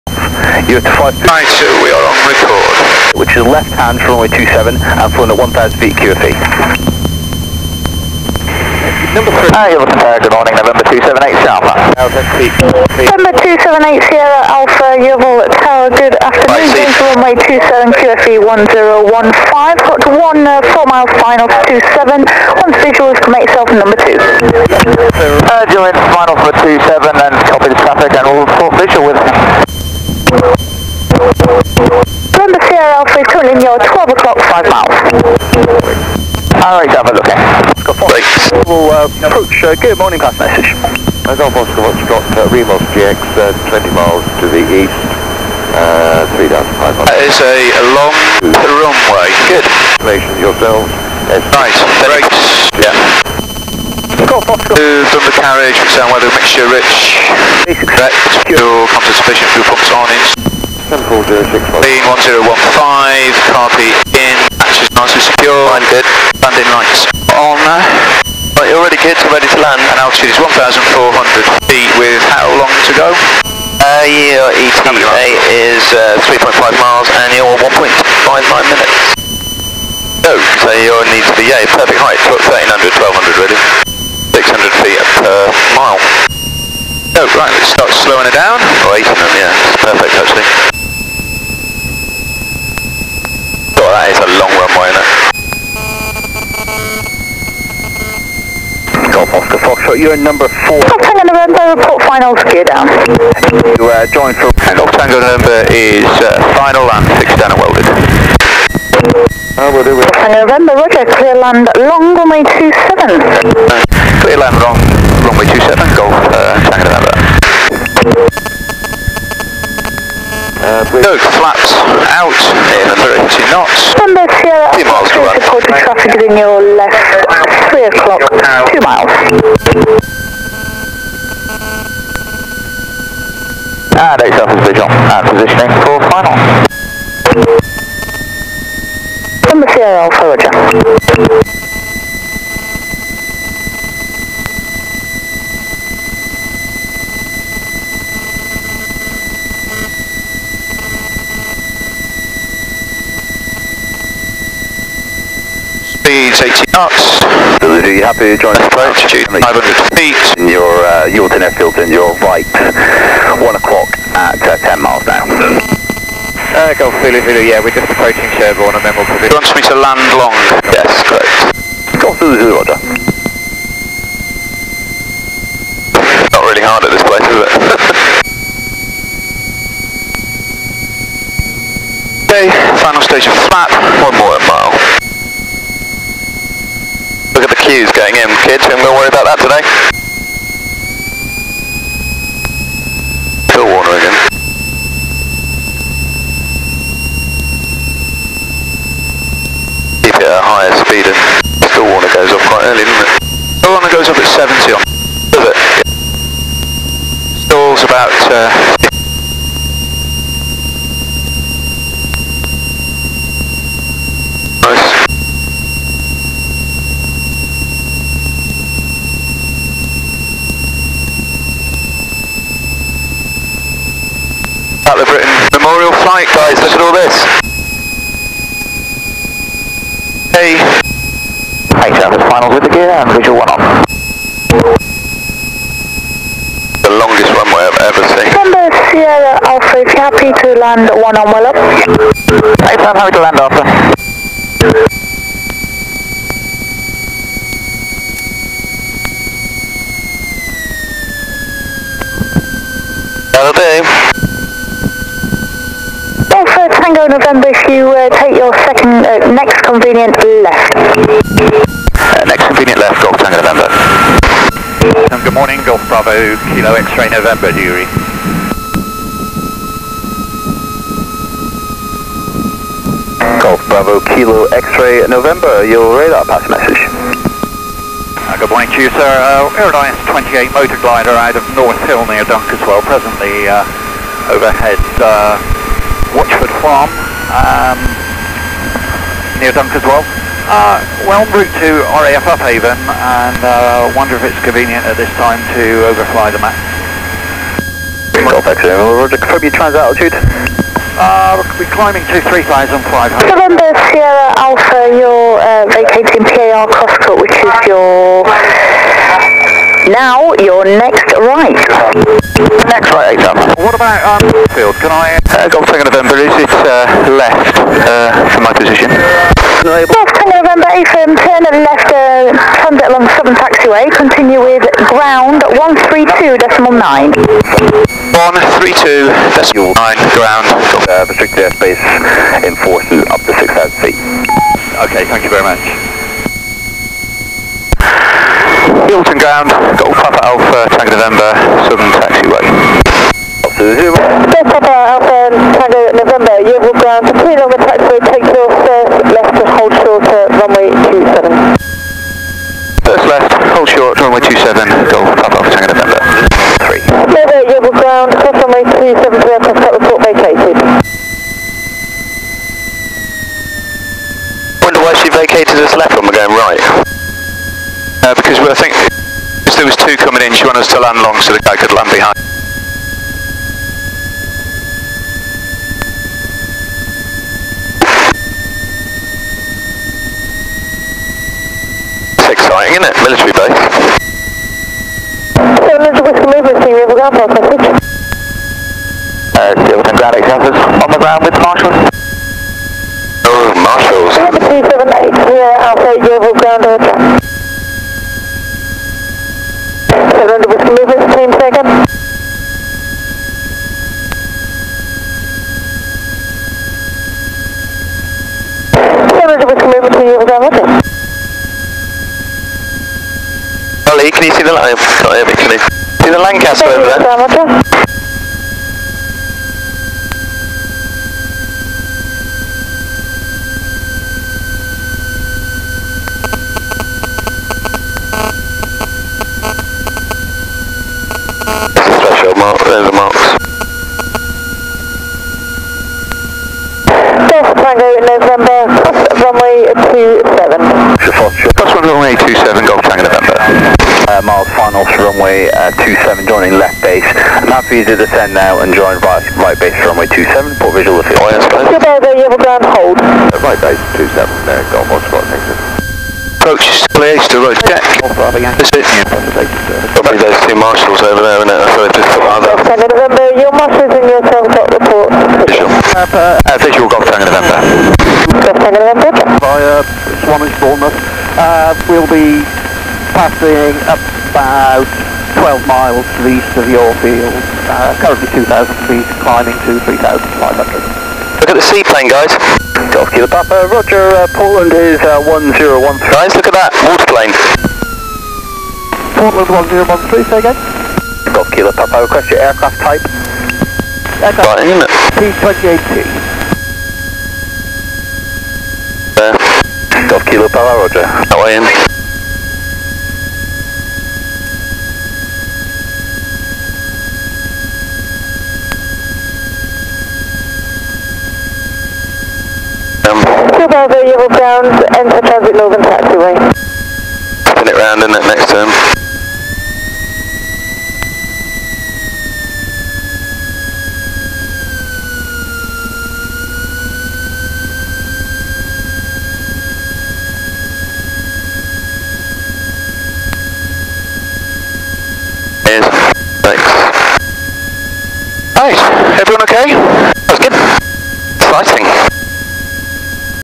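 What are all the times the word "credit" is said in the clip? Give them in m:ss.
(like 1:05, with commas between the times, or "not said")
not said.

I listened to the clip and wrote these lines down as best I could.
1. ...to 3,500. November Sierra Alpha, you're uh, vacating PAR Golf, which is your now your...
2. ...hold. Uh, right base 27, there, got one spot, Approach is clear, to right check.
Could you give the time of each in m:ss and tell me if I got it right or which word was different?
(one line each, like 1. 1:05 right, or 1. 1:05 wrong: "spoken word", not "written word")
1. 5:02 wrong: "Crosscut", not "Golf"
2. 7:32 right.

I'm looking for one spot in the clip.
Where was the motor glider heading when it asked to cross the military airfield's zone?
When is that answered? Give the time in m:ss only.
4:52.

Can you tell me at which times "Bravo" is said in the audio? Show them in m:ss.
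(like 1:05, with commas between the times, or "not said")
4:25, 4:33, 8:33.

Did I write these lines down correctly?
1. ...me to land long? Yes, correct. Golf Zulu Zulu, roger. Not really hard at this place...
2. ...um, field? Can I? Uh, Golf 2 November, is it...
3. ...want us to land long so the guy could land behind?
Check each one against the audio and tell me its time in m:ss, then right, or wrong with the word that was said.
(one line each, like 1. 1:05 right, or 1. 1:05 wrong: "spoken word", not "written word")
1. 2:49 right
2. 5:14 right
3. 6:10 right.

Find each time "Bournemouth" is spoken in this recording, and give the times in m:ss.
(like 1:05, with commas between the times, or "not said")
7:50.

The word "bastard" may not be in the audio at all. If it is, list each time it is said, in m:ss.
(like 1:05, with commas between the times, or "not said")
not said.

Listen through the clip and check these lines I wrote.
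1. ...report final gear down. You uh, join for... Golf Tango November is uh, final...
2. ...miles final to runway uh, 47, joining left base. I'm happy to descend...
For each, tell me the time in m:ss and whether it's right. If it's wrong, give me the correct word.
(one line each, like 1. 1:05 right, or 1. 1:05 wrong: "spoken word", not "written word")
1. 1:41 right
2. 7:24 wrong: "27", not "47".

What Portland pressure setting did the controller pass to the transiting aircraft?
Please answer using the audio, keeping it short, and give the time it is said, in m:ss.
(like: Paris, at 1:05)
1013, at 8:04.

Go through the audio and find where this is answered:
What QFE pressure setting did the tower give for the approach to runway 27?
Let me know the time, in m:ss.
0:17.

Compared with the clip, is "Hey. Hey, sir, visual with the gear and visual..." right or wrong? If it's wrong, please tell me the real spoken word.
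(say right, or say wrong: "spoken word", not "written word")
wrong: "final", not "visual".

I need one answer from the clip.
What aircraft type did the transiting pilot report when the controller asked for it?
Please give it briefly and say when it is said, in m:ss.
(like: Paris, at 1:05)
P28T, at 8:15.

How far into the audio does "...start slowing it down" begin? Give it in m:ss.
1:27.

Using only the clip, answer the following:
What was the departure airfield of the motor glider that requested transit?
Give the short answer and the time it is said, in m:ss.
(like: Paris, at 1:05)
North Hill, at 4:41.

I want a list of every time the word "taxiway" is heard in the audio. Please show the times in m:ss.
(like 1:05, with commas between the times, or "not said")
5:23, 8:35.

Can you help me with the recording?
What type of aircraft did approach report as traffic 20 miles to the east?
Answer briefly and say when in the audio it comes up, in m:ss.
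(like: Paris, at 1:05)
Remos GX, at 0:42.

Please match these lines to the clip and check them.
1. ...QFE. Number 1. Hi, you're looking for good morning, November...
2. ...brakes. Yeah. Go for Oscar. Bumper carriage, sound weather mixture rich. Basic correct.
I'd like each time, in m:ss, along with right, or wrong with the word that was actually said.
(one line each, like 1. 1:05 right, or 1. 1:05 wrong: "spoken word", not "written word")
1. 0:05 wrong: "3", not "1"
2. 0:52 wrong: "Bosco", not "Oscar".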